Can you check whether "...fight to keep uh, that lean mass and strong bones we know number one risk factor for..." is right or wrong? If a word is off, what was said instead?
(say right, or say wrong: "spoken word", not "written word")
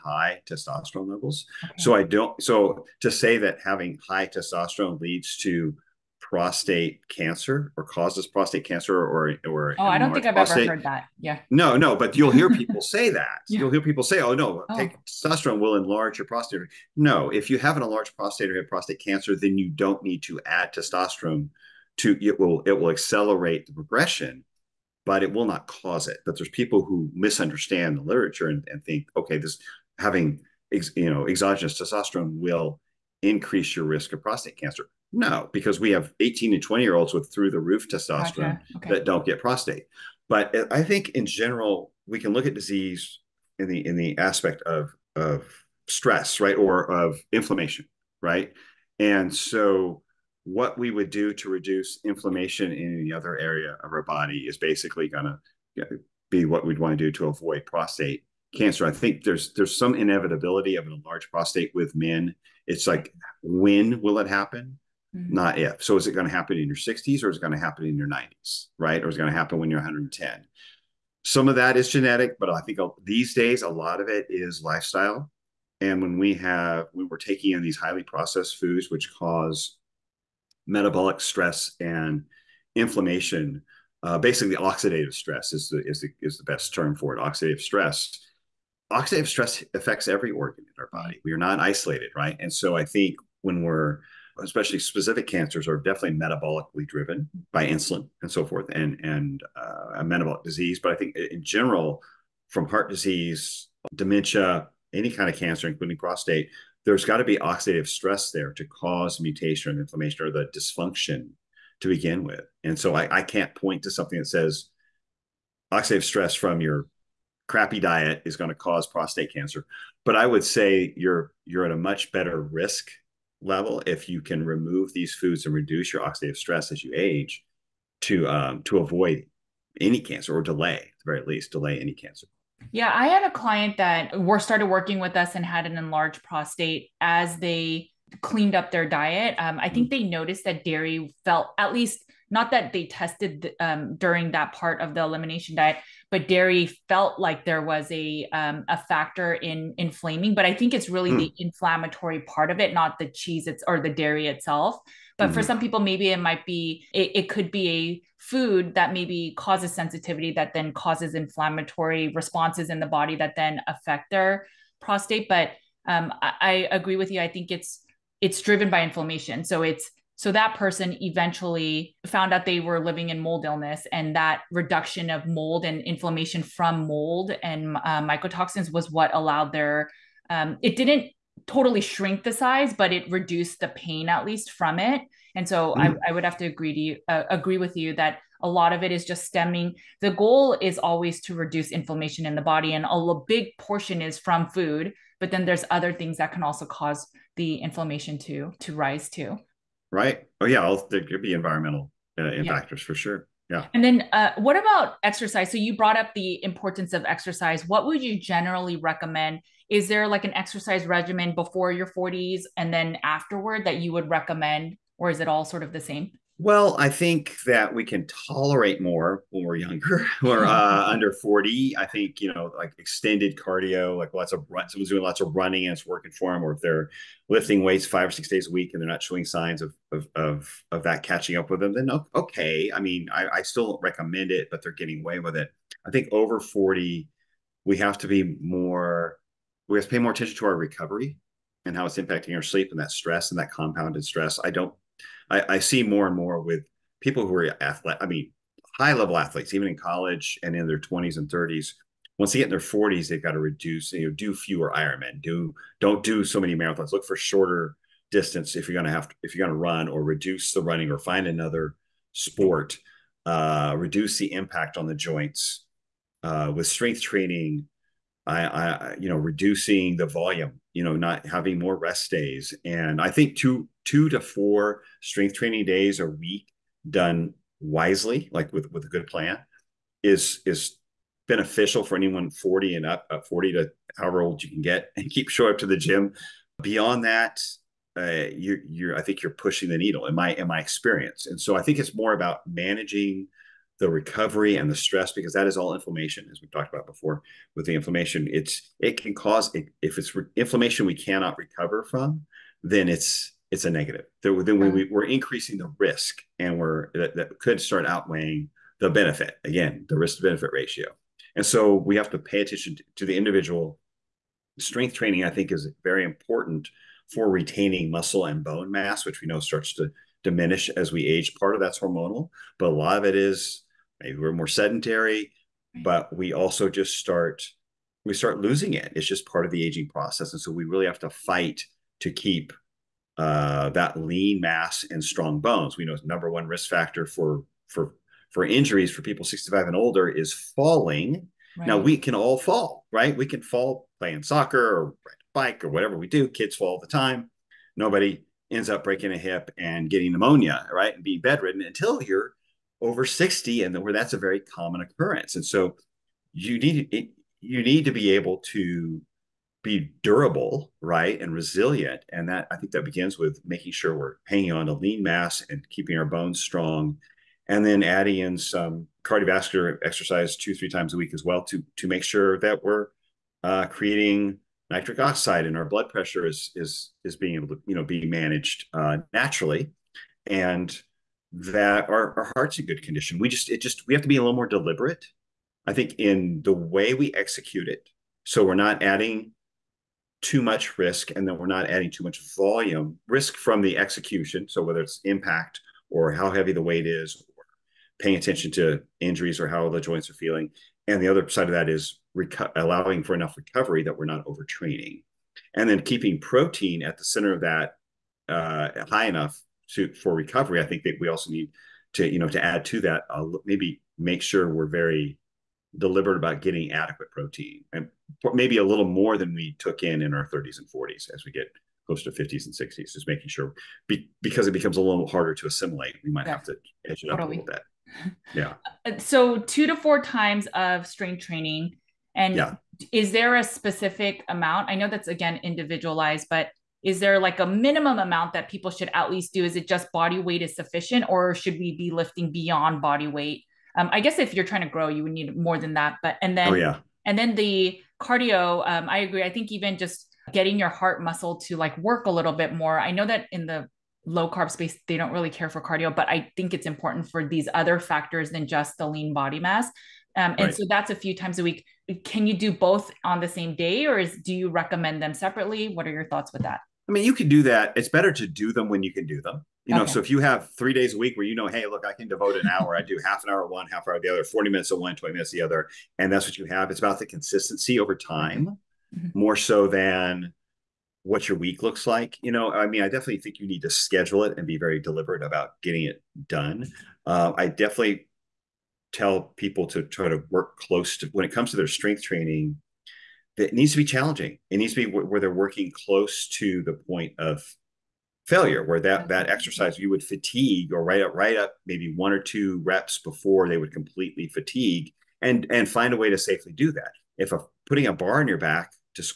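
right.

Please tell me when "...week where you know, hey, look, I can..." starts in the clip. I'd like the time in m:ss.
7:50.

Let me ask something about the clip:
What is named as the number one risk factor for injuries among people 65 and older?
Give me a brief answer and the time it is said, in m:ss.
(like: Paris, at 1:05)
Falling, at 5:40.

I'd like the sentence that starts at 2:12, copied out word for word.
Yeah, I had a client that were started working with us and had an enlarged prostate as they cleaned up their diet.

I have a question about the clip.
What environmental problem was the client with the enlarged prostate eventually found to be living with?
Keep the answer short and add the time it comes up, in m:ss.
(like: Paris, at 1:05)
Mold illness, at 2:53.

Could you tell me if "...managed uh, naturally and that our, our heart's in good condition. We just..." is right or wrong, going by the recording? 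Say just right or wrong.
right.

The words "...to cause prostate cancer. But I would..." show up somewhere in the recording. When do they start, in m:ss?
1:58.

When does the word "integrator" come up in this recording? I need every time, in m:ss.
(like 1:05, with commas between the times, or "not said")
not said.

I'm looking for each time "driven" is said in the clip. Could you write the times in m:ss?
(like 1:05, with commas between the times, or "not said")
1:36, 2:48.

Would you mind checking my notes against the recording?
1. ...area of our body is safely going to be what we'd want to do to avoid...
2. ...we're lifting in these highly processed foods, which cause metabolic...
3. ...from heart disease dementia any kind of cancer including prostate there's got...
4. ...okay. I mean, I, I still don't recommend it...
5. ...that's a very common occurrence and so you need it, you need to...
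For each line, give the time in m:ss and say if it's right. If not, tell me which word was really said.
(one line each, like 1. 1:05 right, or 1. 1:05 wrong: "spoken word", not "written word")
1. 0:53 wrong: "basically", not "safely"
2. 1:17 wrong: "taking", not "lifting"
3. 1:42 right
4. 3:52 right
5. 5:53 right.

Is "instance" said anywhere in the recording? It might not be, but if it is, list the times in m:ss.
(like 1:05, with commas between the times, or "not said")
not said.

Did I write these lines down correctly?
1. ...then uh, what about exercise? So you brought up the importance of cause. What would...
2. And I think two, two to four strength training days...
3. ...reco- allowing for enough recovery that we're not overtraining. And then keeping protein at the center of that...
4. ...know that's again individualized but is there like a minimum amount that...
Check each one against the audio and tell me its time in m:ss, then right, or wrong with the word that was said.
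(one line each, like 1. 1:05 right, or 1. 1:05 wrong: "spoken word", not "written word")
1. 3:23 wrong: "exercise", not "cause"
2. 4:32 right
3. 6:42 right
4. 7:14 right.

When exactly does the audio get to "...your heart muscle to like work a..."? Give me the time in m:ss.
7:30.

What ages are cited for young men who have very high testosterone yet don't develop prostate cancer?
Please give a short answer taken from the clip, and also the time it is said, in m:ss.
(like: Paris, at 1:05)
18 and 20, at 0:36.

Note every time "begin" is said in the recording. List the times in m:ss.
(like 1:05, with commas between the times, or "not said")
1:51, 6:02.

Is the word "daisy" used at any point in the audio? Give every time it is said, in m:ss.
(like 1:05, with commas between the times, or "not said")
not said.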